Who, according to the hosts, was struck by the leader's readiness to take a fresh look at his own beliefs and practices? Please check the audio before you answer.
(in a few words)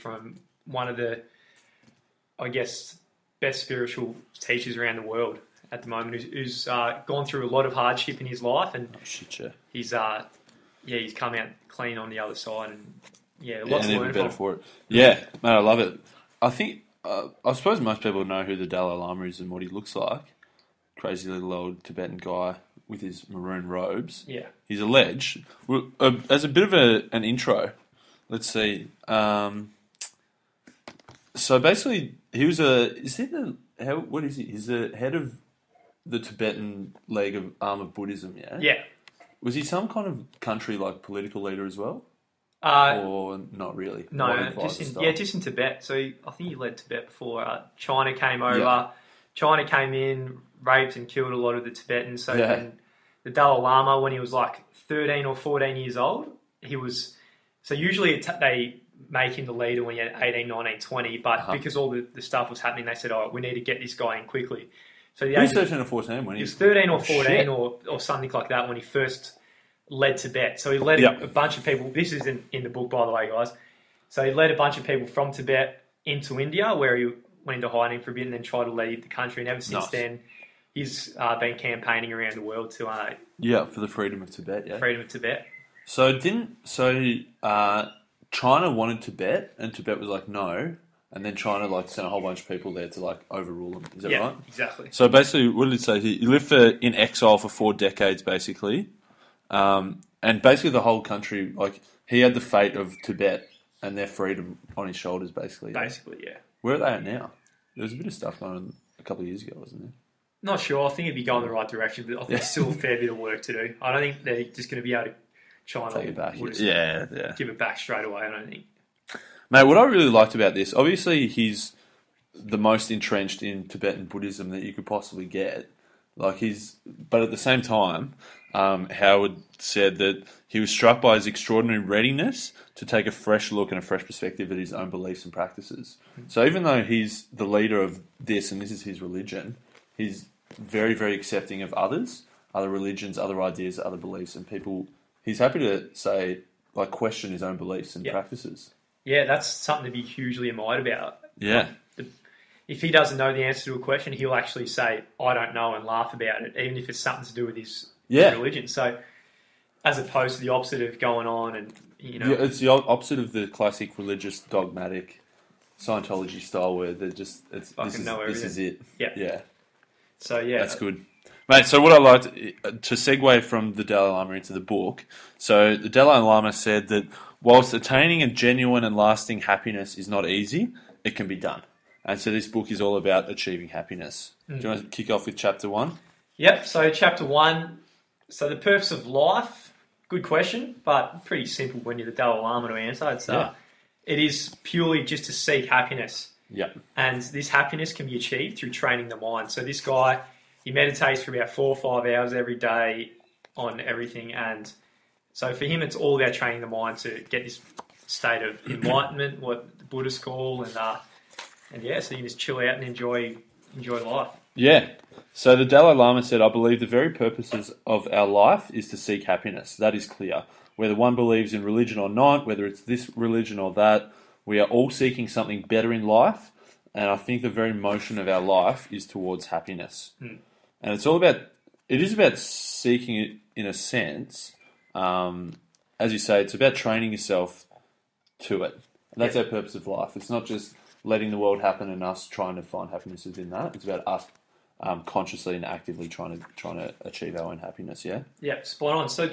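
Howard.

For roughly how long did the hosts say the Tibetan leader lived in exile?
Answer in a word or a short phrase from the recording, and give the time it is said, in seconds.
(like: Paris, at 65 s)
4 decades, at 97 s.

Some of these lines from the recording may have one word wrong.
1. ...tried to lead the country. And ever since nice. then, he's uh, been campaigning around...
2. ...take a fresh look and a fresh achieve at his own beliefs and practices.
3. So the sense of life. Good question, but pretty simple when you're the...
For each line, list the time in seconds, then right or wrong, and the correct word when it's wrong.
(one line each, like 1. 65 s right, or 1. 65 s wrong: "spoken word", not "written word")
1. 78 s right
2. 132 s wrong: "perspective", not "achieve"
3. 188 s wrong: "purpose", not "sense".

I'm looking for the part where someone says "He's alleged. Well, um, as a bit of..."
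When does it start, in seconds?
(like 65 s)
24 s.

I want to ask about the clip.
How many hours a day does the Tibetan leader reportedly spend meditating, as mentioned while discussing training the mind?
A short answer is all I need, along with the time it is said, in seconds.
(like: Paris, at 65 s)
4 or 5, at 201 s.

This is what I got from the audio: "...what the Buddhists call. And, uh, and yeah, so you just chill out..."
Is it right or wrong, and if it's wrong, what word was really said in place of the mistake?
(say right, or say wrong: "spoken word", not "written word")
right.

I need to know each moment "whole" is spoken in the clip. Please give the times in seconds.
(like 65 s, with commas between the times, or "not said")
92 s, 100 s.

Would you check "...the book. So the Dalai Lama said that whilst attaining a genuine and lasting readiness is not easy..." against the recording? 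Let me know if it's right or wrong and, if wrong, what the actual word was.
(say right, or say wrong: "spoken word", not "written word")
wrong: "happiness", not "readiness".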